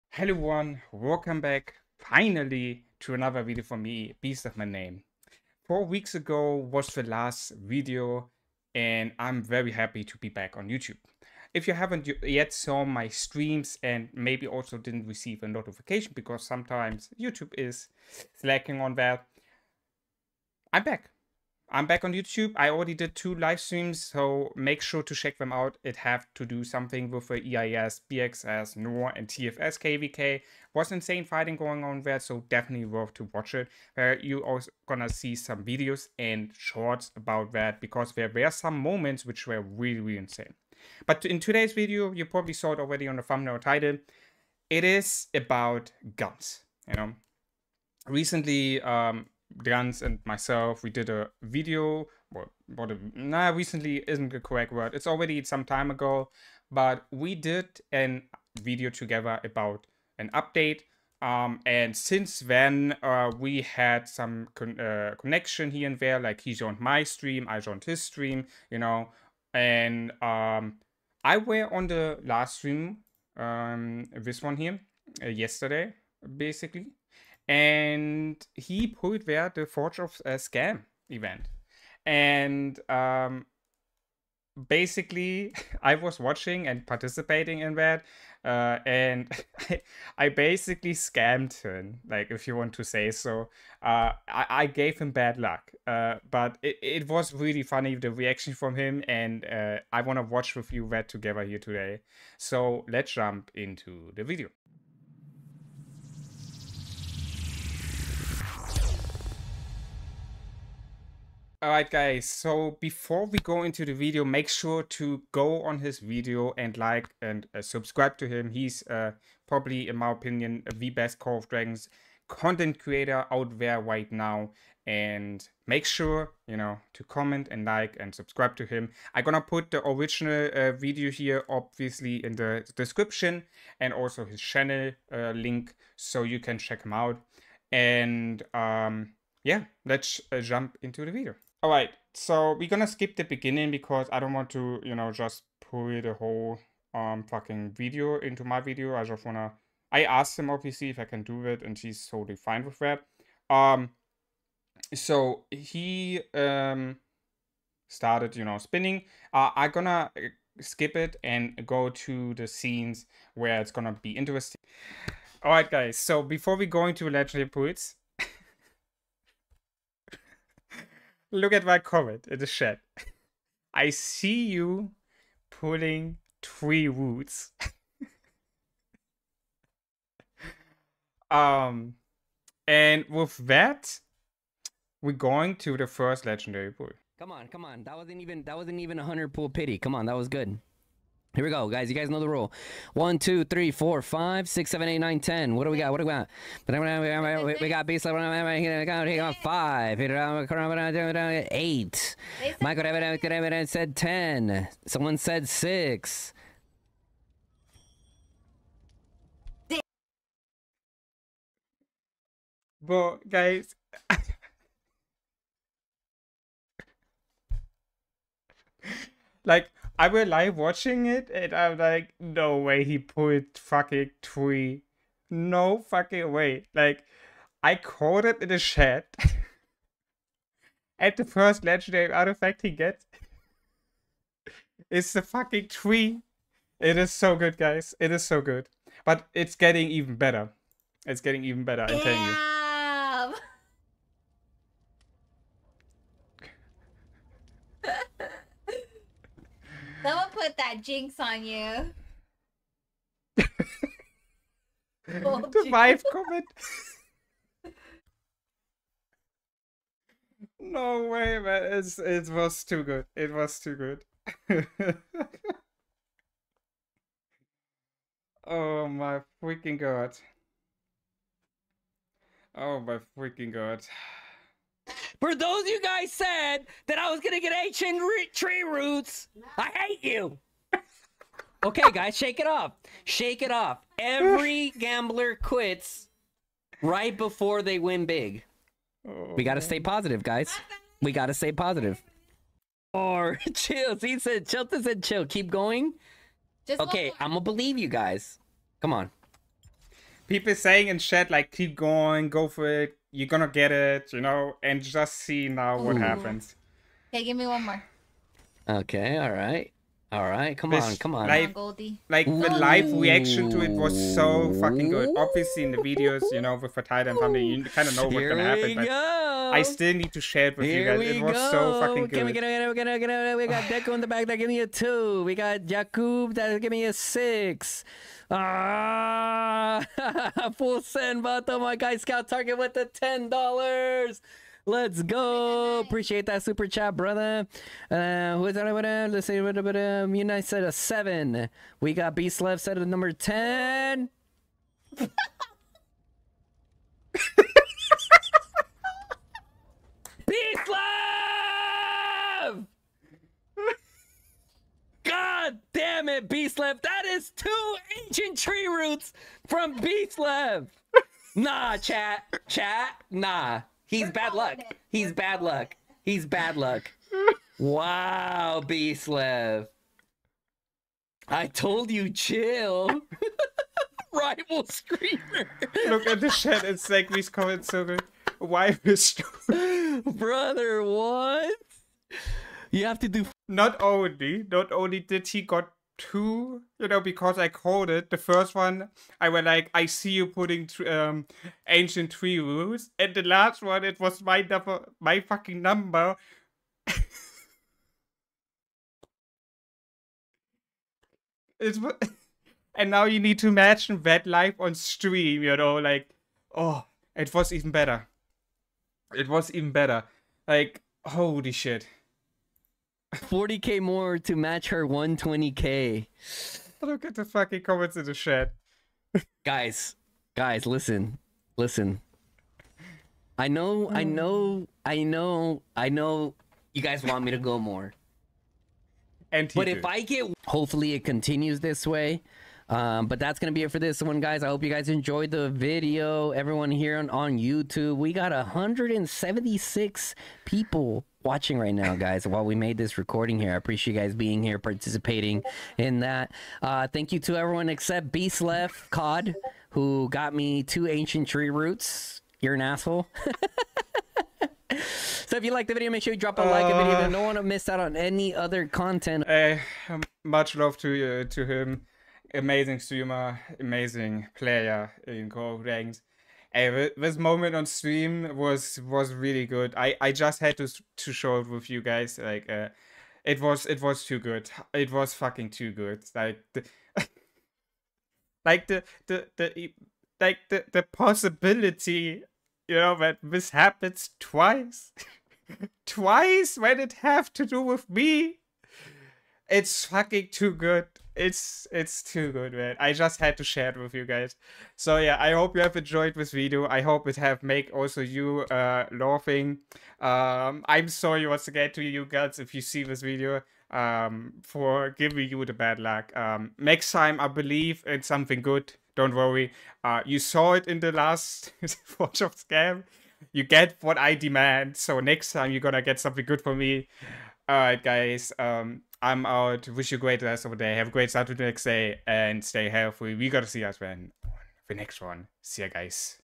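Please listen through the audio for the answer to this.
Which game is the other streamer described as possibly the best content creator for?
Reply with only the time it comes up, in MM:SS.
02:01.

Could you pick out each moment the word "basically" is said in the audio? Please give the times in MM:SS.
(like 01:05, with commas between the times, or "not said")
01:16, 01:24, 01:30.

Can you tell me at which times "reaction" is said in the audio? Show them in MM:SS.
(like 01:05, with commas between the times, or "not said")
01:38, 05:12.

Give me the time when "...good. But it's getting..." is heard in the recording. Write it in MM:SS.
03:58.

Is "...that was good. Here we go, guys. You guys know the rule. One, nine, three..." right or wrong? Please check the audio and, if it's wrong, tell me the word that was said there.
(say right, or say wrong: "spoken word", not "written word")
wrong: "two", not "nine".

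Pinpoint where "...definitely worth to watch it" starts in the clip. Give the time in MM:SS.
00:32.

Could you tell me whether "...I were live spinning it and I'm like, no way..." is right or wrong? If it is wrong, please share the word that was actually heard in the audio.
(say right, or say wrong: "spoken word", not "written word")
wrong: "watching", not "spinning".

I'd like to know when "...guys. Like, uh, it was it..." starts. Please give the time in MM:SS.
07:51.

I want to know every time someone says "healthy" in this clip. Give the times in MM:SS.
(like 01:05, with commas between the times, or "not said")
08:42.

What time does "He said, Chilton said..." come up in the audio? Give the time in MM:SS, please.
04:54.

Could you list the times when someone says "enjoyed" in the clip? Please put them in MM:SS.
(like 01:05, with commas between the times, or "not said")
07:14, 08:15.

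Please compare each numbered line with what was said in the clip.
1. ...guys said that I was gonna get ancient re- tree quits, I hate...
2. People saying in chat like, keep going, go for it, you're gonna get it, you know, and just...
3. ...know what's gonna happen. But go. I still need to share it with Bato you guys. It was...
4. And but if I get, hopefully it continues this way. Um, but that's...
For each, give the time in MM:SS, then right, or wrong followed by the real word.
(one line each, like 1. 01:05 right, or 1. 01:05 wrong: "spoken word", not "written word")
1. 04:35 wrong: "roots", not "quits"
2. 05:00 right
3. 05:17 wrong: "Here", not "Bato"
4. 07:09 right.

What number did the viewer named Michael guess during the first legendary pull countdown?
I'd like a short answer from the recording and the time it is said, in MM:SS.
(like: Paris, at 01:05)
10, at 03:22.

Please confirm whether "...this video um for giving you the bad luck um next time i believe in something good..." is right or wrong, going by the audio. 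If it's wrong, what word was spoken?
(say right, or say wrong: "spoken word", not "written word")
right.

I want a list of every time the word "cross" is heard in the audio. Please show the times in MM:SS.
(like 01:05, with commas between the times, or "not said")
not said.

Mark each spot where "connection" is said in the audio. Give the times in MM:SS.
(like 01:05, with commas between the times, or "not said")
01:05.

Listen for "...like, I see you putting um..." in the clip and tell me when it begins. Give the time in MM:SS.
06:29.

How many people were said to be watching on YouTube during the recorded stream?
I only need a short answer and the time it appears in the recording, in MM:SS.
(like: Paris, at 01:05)
176, at 07:18.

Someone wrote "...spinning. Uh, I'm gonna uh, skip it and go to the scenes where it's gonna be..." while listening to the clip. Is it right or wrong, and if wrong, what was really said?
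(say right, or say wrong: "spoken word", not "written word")
right.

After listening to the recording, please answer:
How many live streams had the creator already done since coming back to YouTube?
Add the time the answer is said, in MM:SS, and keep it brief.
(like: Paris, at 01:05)
2, at 00:23.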